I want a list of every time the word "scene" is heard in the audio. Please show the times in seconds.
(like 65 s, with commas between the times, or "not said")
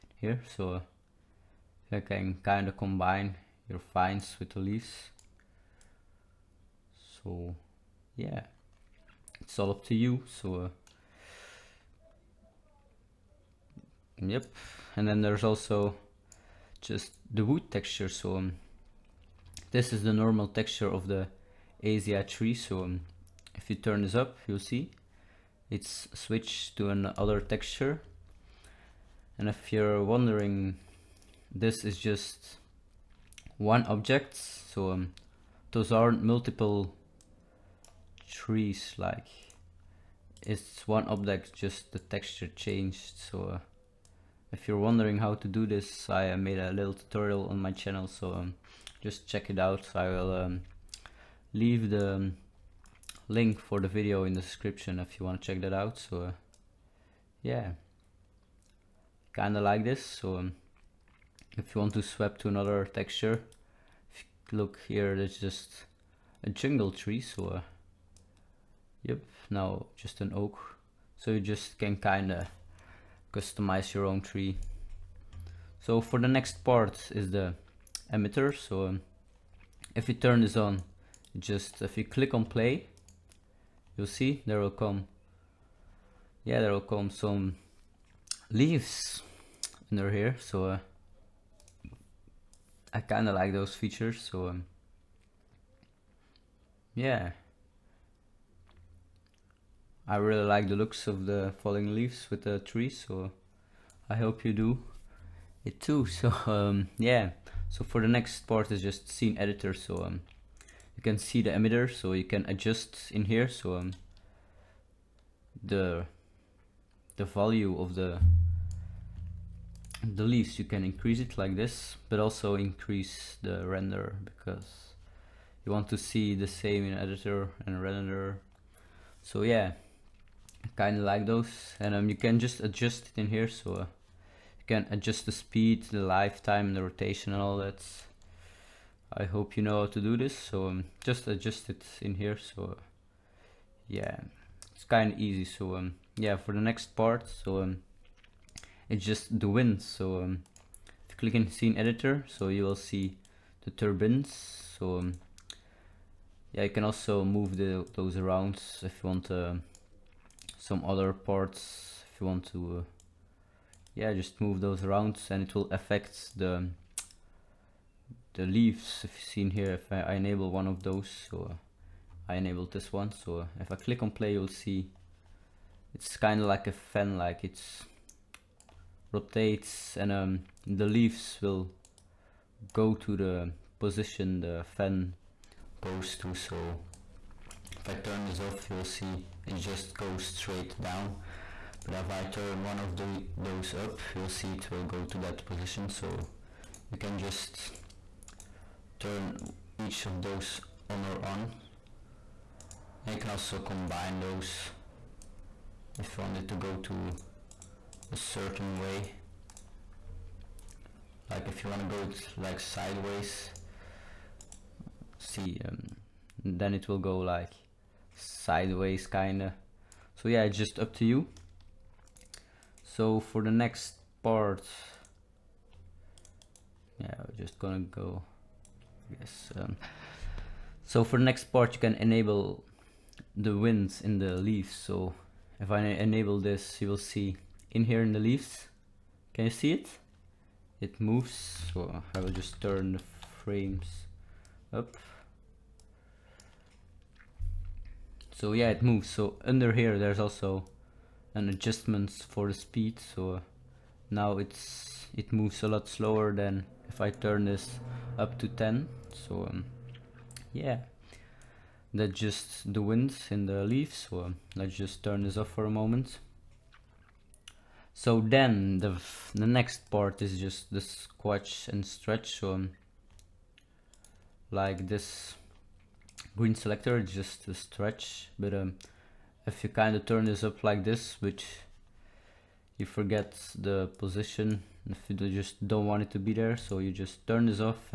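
109 s, 151 s.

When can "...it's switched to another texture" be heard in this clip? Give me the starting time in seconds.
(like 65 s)
25 s.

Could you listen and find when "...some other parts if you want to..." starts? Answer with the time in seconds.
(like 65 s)
160 s.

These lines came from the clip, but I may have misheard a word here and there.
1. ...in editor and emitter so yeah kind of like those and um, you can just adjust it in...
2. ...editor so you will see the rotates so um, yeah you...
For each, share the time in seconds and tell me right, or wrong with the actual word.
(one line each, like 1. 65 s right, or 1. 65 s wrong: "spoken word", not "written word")
1. 126 s wrong: "render", not "emitter"
2. 151 s wrong: "turbines", not "rotates".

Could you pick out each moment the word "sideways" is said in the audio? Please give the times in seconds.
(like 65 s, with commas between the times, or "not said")
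212 s, 218 s.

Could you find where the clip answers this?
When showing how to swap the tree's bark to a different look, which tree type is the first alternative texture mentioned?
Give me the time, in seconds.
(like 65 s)
66 s.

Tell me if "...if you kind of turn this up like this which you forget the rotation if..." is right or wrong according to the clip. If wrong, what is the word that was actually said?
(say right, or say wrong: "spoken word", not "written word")
wrong: "position", not "rotation".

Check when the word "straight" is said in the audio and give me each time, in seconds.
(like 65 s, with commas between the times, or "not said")
190 s.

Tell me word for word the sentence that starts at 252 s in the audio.
So now it's it moves a lot slower than if I turn this up to 10.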